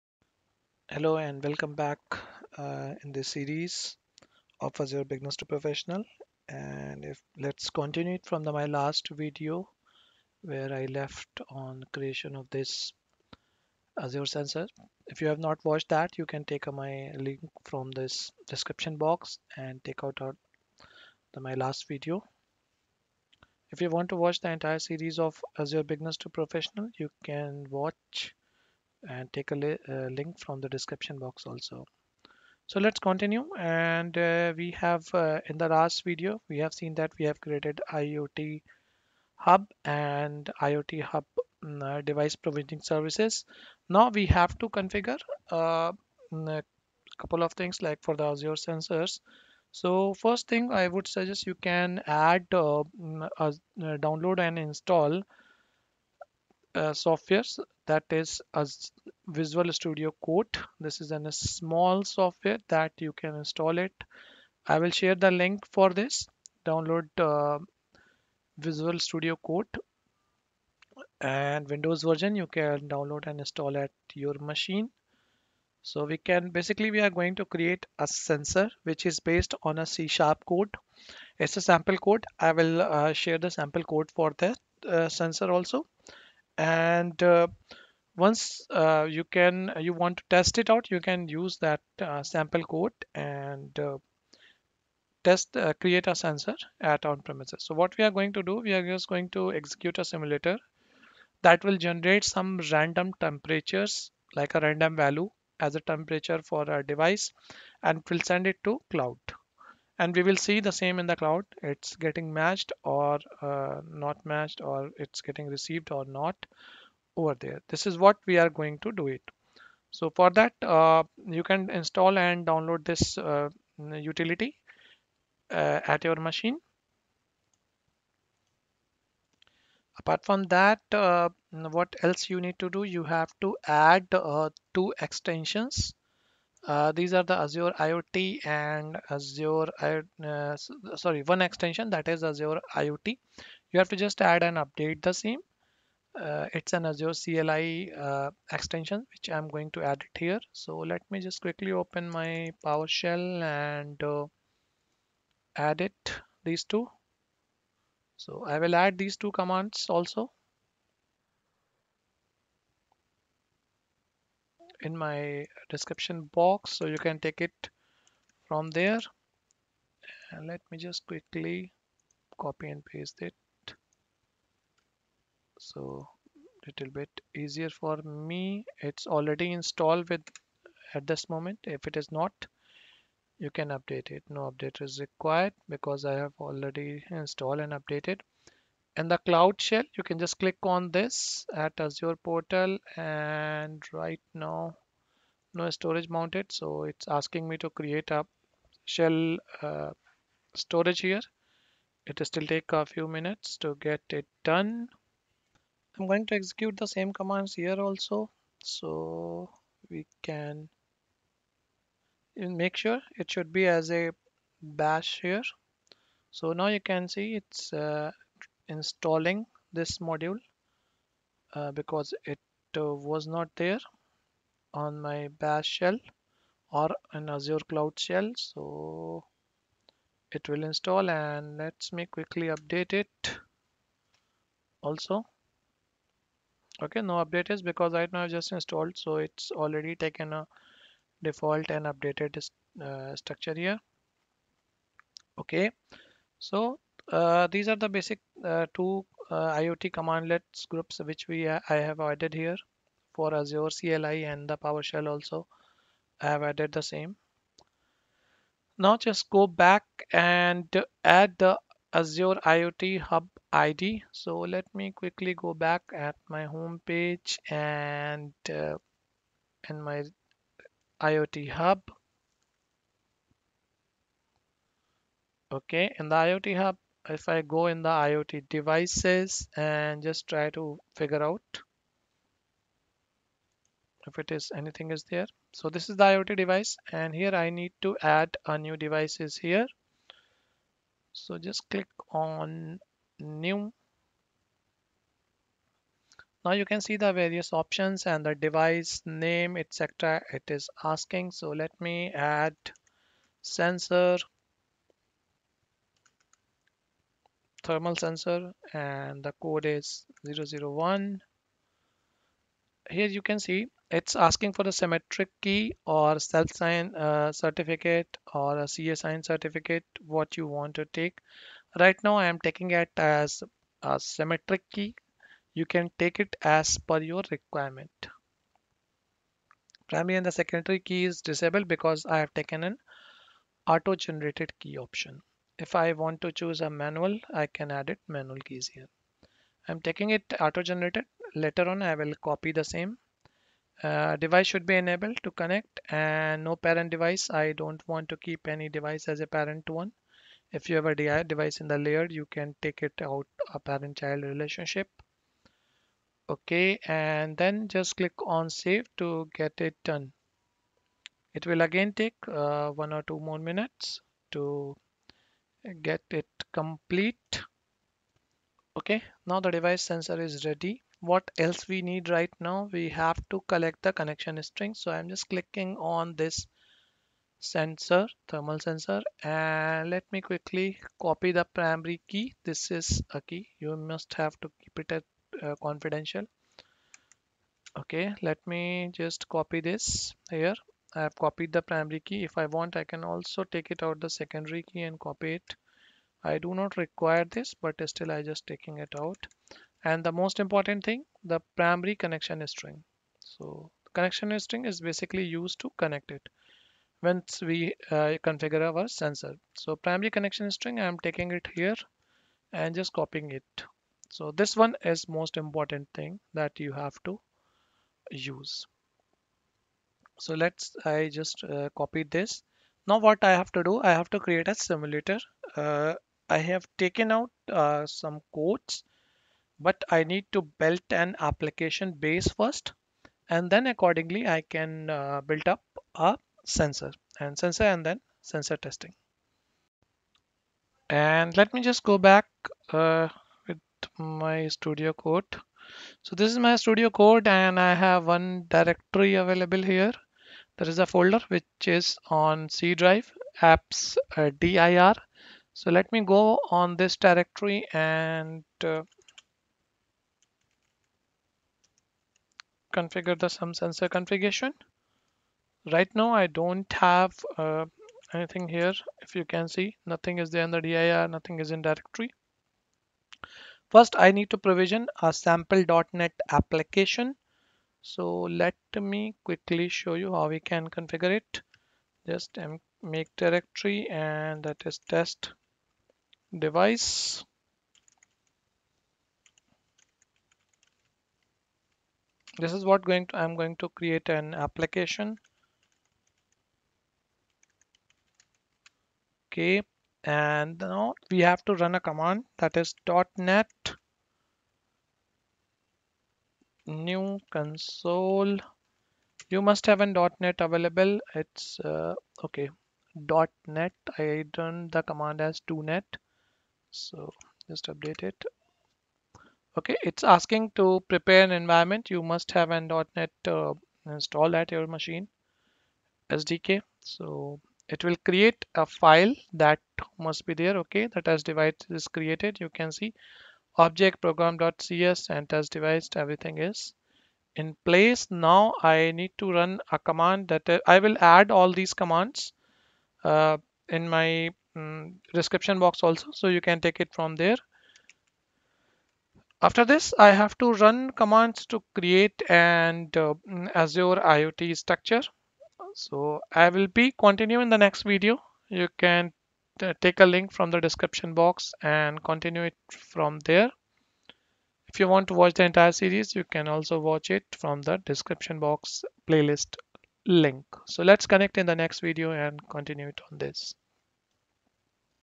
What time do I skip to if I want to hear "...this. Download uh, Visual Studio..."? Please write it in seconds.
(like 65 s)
65 s.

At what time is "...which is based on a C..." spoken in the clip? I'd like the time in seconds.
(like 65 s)
78 s.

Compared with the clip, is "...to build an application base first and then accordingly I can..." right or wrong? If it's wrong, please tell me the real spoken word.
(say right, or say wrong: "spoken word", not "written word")
right.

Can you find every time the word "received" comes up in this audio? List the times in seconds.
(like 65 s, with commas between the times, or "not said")
115 s.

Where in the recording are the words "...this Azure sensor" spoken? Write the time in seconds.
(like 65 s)
12 s.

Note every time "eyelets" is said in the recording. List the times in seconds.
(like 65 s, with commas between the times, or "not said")
not said.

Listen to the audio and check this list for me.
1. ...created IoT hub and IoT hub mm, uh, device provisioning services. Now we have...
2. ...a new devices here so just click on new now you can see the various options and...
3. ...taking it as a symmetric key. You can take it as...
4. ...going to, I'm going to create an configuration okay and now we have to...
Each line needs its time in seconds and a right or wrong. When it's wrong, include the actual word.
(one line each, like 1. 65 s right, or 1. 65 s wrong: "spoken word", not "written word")
1. 37 s right
2. 288 s right
3. 322 s right
4. 492 s wrong: "application", not "configuration".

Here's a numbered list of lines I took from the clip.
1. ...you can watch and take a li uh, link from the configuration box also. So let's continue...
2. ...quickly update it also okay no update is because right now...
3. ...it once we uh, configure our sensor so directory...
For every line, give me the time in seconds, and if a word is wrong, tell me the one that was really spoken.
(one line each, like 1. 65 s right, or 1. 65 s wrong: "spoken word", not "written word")
1. 26 s wrong: "description", not "configuration"
2. 232 s right
3. 406 s wrong: "primary", not "directory".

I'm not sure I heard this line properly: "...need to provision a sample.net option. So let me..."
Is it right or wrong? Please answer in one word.
wrong.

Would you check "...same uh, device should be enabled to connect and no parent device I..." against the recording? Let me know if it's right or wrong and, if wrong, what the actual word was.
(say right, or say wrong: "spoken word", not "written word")
right.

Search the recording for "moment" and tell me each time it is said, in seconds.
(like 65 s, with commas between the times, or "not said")
181 s.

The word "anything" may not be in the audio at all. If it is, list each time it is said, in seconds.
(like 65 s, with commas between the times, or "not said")
284 s, 468 s.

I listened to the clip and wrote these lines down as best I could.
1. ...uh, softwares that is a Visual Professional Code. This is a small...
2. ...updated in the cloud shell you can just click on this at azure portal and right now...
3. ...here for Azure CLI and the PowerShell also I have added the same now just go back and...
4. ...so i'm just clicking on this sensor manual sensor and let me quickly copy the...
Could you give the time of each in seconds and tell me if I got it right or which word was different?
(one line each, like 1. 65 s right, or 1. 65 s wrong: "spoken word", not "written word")
1. 56 s wrong: "Studio", not "Professional"
2. 187 s right
3. 252 s right
4. 374 s wrong: "thermal", not "manual".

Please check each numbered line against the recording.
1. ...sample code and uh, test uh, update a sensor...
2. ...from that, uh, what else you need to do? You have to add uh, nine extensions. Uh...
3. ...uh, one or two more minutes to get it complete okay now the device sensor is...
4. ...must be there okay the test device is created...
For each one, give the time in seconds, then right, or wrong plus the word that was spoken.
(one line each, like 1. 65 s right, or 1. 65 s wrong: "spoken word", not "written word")
1. 92 s wrong: "create", not "update"
2. 130 s wrong: "two", not "nine"
3. 362 s right
4. 529 s right.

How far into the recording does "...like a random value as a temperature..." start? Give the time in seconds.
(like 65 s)
104 s.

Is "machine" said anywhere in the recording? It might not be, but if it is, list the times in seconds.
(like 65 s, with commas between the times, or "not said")
74 s, 126 s, 524 s.